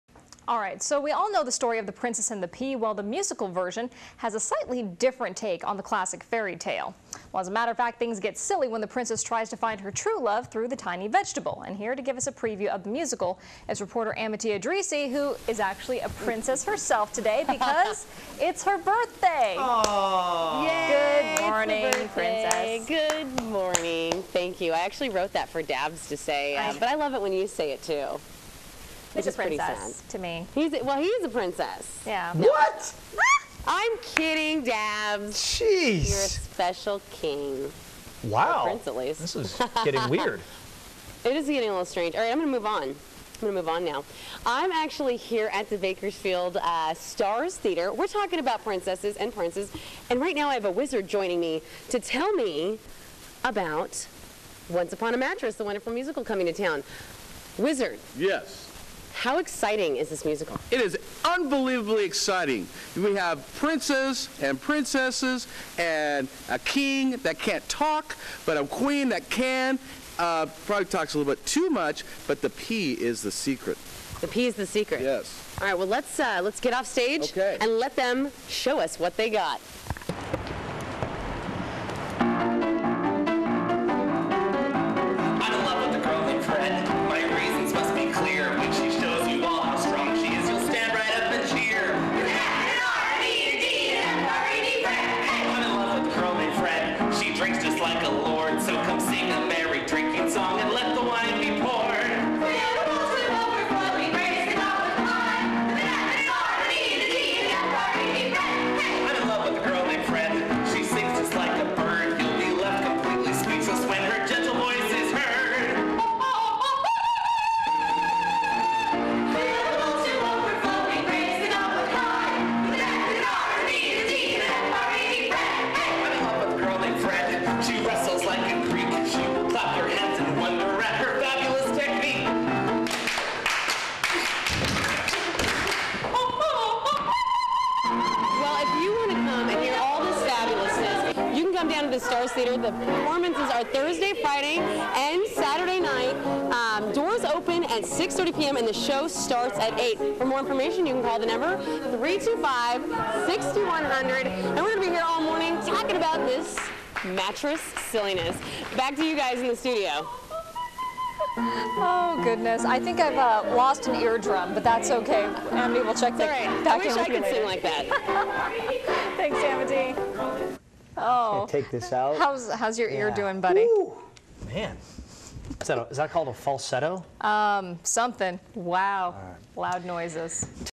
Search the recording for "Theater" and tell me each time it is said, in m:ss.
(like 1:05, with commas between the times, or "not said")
0:47, 2:22.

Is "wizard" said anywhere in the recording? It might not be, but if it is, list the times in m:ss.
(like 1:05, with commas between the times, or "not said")
0:50, 0:57.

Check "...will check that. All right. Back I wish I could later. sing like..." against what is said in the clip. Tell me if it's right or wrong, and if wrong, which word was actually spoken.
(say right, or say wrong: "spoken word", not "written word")
right.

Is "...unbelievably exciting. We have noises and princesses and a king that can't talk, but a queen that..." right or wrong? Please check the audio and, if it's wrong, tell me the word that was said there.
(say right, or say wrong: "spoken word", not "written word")
wrong: "princes", not "noises".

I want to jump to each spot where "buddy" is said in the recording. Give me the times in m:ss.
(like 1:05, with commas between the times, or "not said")
2:53.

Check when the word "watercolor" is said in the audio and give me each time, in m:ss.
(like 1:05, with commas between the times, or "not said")
not said.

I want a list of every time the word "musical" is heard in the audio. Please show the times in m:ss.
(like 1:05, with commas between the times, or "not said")
0:03, 0:12, 0:55, 1:00.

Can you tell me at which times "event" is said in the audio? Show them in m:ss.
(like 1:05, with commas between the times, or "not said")
not said.